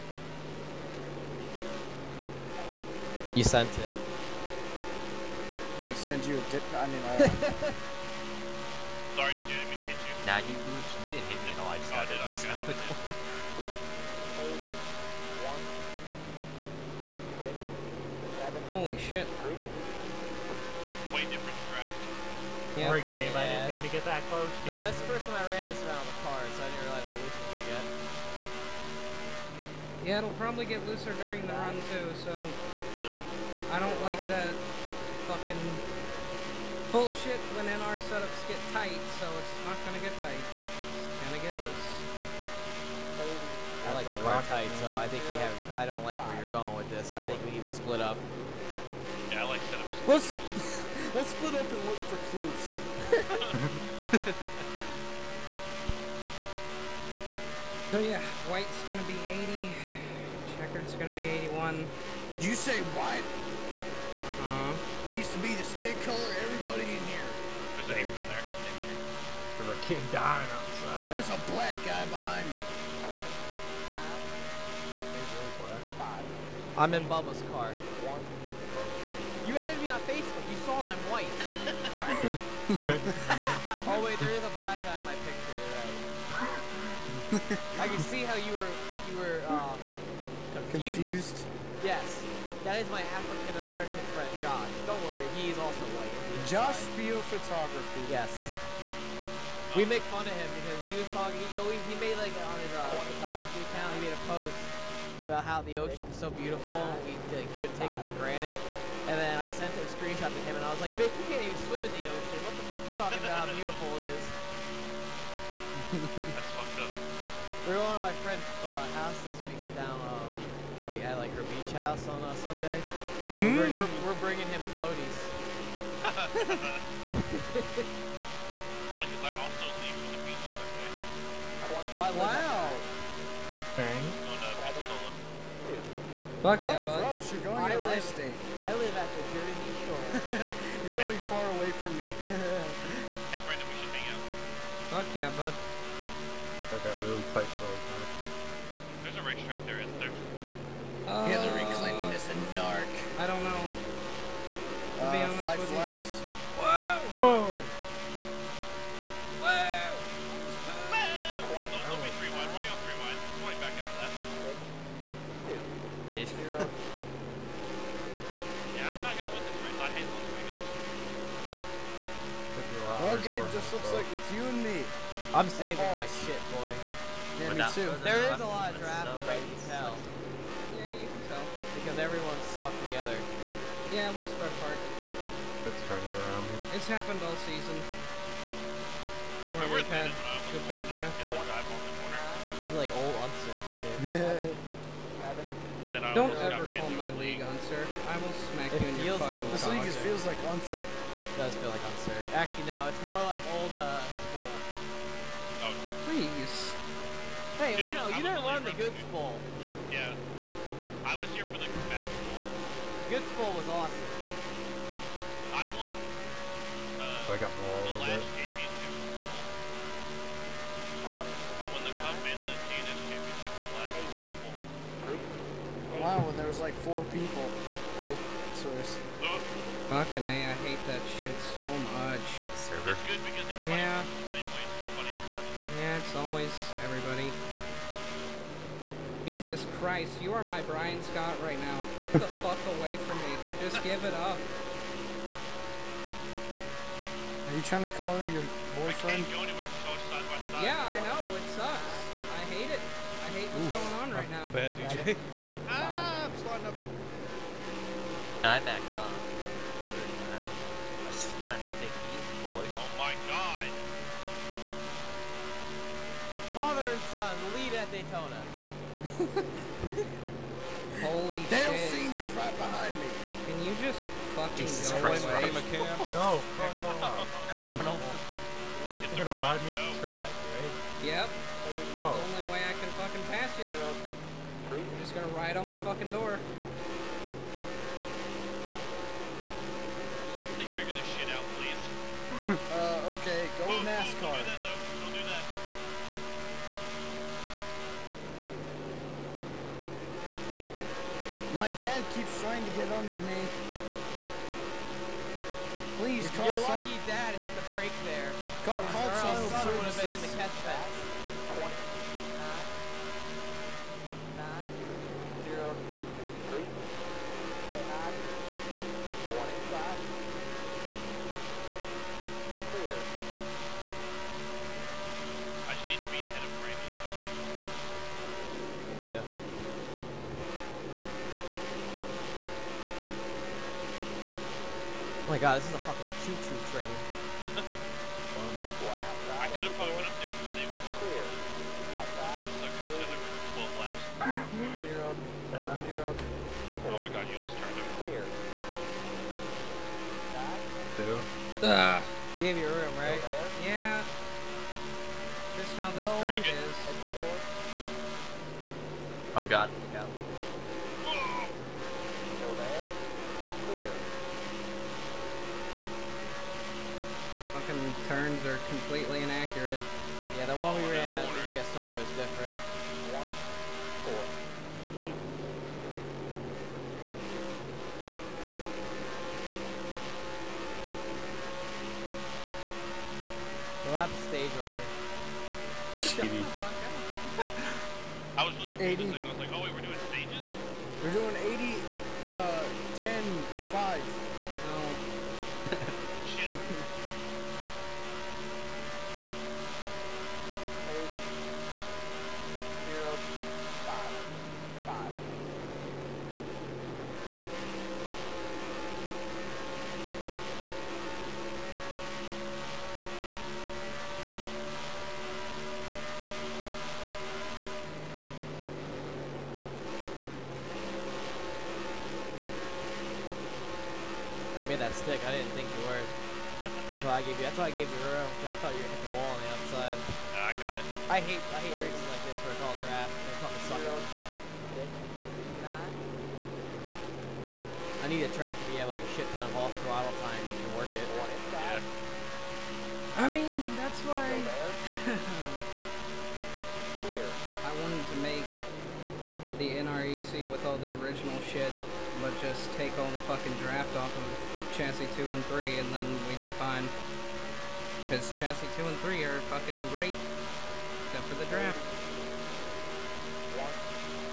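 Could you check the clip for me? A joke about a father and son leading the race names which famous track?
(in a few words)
Daytona.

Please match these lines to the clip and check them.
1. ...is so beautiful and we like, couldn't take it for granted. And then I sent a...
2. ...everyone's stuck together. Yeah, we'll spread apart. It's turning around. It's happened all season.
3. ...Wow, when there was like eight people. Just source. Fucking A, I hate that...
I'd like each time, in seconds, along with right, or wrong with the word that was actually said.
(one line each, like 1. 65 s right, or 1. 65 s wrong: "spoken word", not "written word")
1. 106 s right
2. 182 s right
3. 225 s wrong: "four", not "eight".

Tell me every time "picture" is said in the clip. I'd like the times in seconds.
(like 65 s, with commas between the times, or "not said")
85 s.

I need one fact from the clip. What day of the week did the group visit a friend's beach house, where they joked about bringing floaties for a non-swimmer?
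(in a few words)
Sunday.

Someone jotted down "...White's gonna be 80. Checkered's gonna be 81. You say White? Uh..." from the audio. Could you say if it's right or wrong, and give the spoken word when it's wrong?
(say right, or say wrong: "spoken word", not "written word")
right.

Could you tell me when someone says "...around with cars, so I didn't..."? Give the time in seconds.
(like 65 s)
25 s.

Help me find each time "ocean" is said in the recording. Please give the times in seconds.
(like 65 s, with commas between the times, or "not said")
105 s, 112 s.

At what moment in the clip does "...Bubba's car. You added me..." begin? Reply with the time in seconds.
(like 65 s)
77 s.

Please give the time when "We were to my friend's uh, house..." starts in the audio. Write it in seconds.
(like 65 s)
117 s.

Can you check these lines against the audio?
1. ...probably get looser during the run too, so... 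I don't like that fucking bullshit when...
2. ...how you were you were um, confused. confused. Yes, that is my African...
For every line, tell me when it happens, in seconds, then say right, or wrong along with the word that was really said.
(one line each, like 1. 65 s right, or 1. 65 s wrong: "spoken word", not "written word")
1. 30 s right
2. 88 s right.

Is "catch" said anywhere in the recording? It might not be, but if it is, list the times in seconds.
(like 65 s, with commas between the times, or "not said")
310 s.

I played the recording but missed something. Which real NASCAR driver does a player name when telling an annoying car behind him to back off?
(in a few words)
Brian Scott.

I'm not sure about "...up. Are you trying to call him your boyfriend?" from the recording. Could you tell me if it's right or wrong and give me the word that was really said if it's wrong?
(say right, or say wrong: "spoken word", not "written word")
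right.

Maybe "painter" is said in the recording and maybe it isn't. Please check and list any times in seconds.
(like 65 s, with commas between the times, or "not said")
not said.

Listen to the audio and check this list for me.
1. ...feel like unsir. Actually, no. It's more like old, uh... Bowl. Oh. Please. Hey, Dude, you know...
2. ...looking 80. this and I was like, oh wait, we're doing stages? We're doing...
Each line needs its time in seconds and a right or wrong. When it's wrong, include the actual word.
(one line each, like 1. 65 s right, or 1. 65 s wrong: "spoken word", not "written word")
1. 201 s right
2. 388 s right.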